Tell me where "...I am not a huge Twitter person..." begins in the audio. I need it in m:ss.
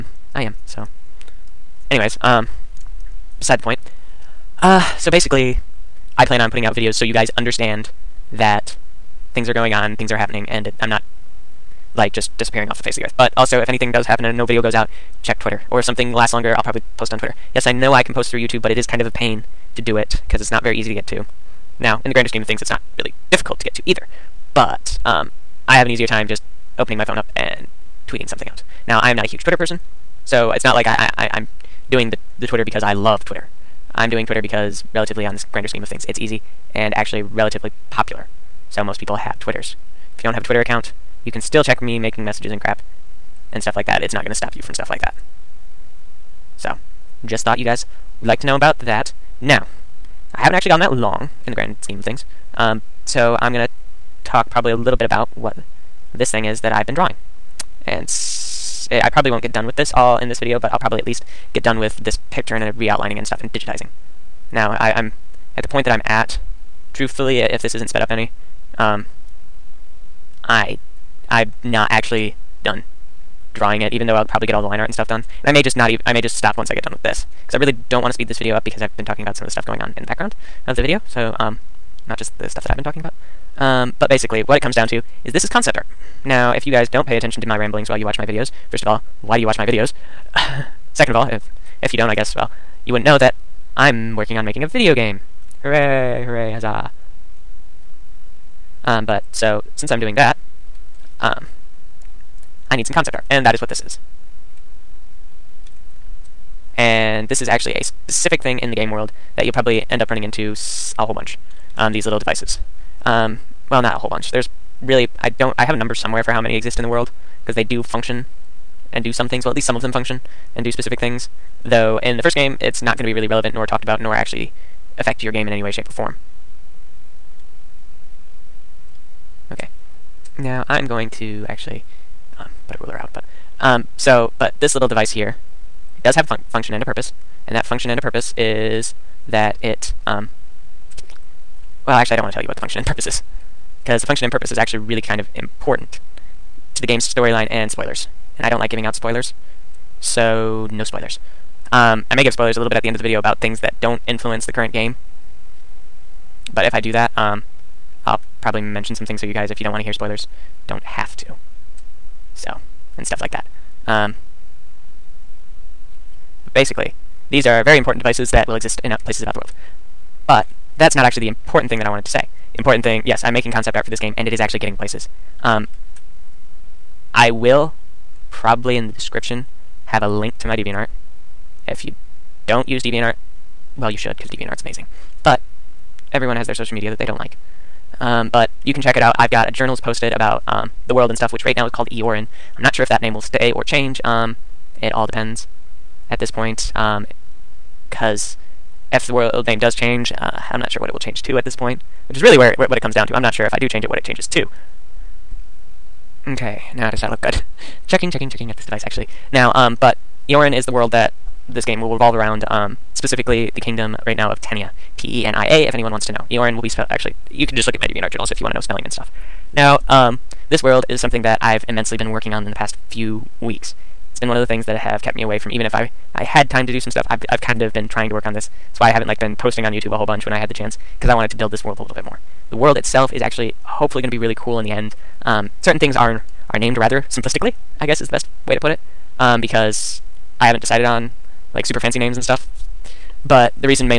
0:29.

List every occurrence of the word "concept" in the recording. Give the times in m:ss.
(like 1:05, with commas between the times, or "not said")
1:25, 1:42, 2:53.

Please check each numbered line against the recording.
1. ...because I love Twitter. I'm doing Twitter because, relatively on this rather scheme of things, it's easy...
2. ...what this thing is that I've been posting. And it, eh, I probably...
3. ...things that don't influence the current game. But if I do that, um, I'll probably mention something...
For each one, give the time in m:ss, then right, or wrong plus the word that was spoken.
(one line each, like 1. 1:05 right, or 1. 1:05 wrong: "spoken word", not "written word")
1. 0:32 wrong: "grander", not "rather"
2. 0:55 wrong: "drawing", not "posting"
3. 2:33 right.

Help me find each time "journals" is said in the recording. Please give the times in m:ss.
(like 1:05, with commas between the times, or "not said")
3:09, 3:38.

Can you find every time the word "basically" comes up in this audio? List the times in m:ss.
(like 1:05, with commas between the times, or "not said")
0:05, 1:24, 2:46.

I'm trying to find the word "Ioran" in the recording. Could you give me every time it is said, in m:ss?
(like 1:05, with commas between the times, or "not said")
3:11, 3:30, 3:36.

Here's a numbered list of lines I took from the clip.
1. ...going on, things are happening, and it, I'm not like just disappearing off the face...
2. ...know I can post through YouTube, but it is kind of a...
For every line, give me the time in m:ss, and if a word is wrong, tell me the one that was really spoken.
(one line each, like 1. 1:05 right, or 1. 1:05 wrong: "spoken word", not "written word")
1. 0:09 right
2. 0:17 right.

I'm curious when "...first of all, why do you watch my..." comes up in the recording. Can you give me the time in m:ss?
1:28.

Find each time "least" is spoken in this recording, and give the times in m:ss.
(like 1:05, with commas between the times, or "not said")
1:01, 1:59.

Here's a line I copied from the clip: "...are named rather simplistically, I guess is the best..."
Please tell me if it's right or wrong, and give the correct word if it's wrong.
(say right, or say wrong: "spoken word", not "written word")
right.